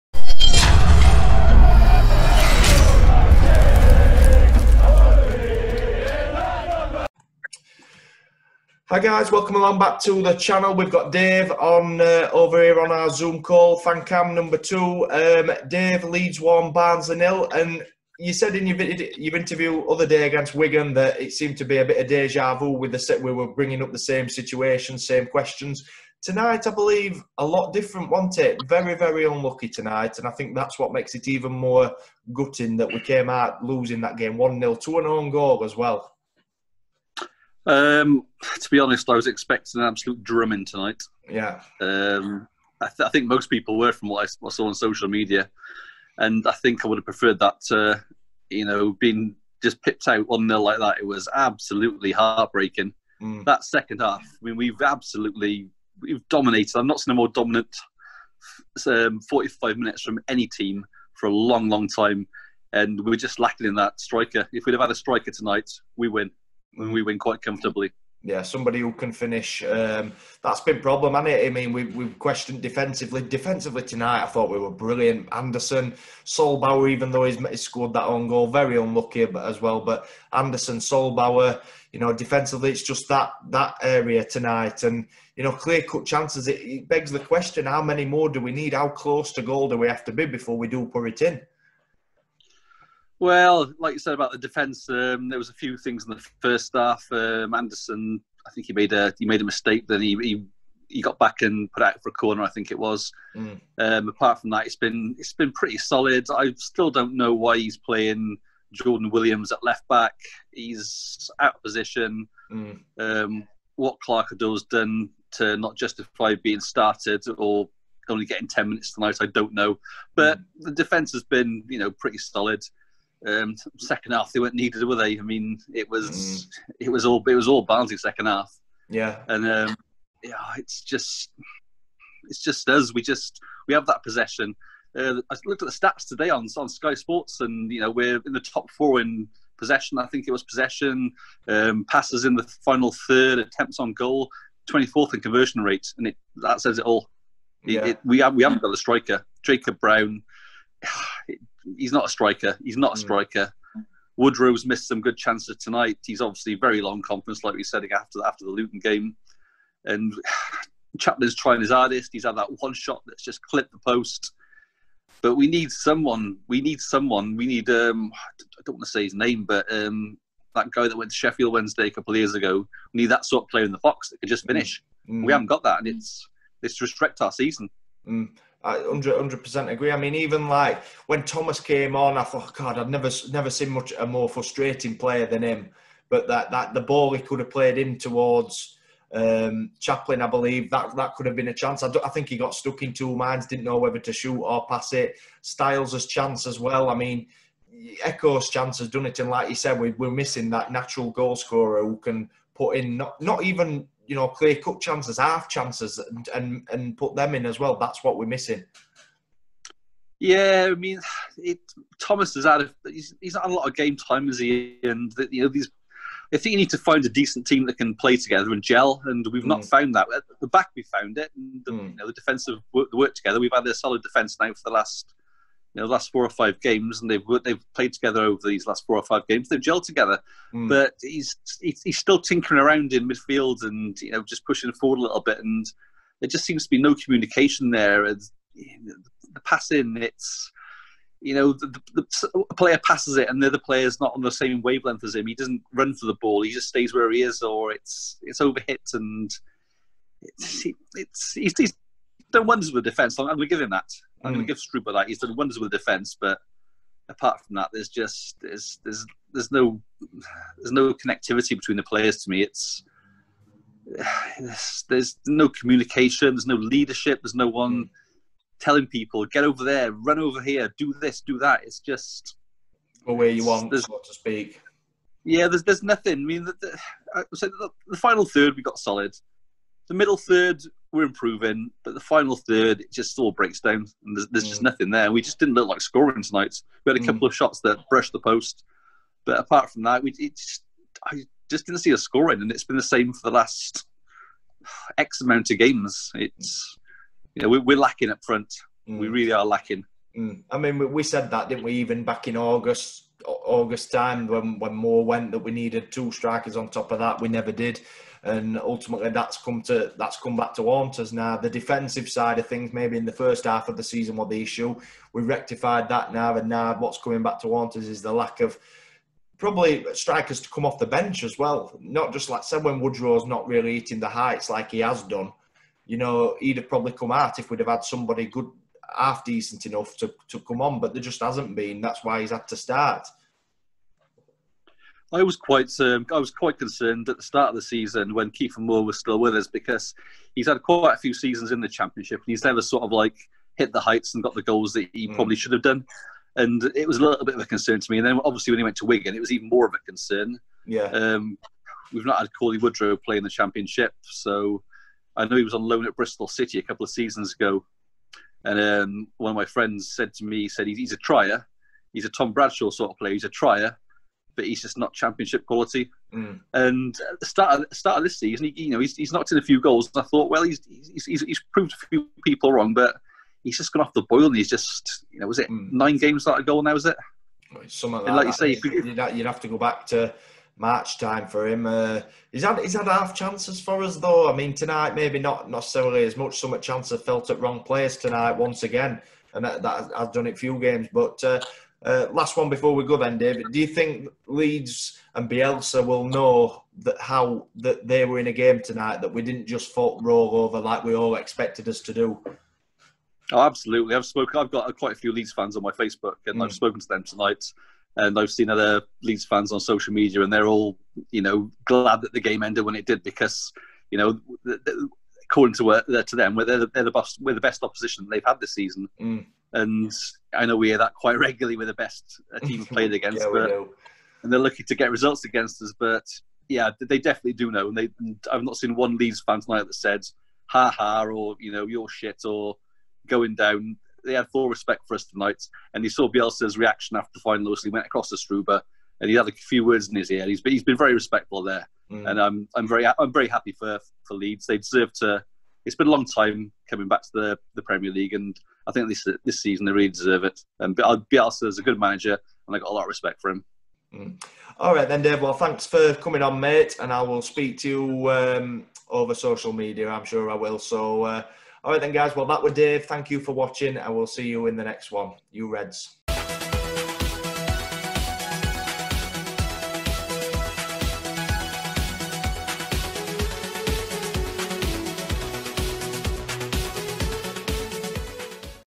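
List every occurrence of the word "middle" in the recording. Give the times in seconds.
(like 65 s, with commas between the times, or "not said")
279 s.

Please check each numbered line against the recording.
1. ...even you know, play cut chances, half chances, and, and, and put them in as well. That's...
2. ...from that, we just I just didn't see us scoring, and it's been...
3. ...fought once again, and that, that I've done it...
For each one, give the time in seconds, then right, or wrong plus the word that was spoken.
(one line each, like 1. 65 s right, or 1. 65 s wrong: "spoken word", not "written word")
1. 203 s right
2. 289 s right
3. 387 s wrong: "tonight", not "fought".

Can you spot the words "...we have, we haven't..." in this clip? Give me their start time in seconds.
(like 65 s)
148 s.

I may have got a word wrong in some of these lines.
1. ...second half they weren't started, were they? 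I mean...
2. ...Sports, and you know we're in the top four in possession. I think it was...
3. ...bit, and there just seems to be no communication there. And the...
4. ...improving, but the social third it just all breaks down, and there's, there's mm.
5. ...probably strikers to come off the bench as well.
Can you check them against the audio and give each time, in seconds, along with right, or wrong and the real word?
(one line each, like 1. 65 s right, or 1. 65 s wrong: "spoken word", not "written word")
1. 123 s wrong: "needed", not "started"
2. 136 s right
3. 235 s right
4. 281 s wrong: "final", not "social"
5. 319 s right.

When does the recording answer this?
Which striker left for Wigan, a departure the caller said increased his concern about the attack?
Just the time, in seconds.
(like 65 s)
338 s.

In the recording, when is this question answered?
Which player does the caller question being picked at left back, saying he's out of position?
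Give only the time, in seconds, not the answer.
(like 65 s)
108 s.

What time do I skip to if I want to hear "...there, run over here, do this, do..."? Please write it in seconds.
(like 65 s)
269 s.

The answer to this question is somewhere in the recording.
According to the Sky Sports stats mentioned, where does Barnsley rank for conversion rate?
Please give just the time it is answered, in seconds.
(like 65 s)
144 s.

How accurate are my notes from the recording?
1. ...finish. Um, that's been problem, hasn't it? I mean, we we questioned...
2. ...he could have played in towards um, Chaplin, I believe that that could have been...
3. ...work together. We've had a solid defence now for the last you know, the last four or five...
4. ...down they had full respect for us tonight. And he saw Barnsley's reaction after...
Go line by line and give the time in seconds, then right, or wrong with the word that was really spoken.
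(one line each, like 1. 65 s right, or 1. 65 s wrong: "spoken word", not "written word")
1. 69 s right
2. 187 s right
3. 222 s right
4. 433 s wrong: "Bielsa", not "Barnsley".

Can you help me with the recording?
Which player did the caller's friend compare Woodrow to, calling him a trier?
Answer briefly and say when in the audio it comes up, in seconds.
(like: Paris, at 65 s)
Tom Bradshaw, at 362 s.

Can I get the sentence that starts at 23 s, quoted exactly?
We were bringing up the same situation, same questions.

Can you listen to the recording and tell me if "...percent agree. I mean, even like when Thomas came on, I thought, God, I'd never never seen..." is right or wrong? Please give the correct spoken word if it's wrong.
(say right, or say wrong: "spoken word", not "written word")
right.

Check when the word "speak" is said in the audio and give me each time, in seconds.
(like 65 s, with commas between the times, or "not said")
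274 s, 457 s.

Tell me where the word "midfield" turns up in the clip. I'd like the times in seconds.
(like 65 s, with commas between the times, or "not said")
233 s.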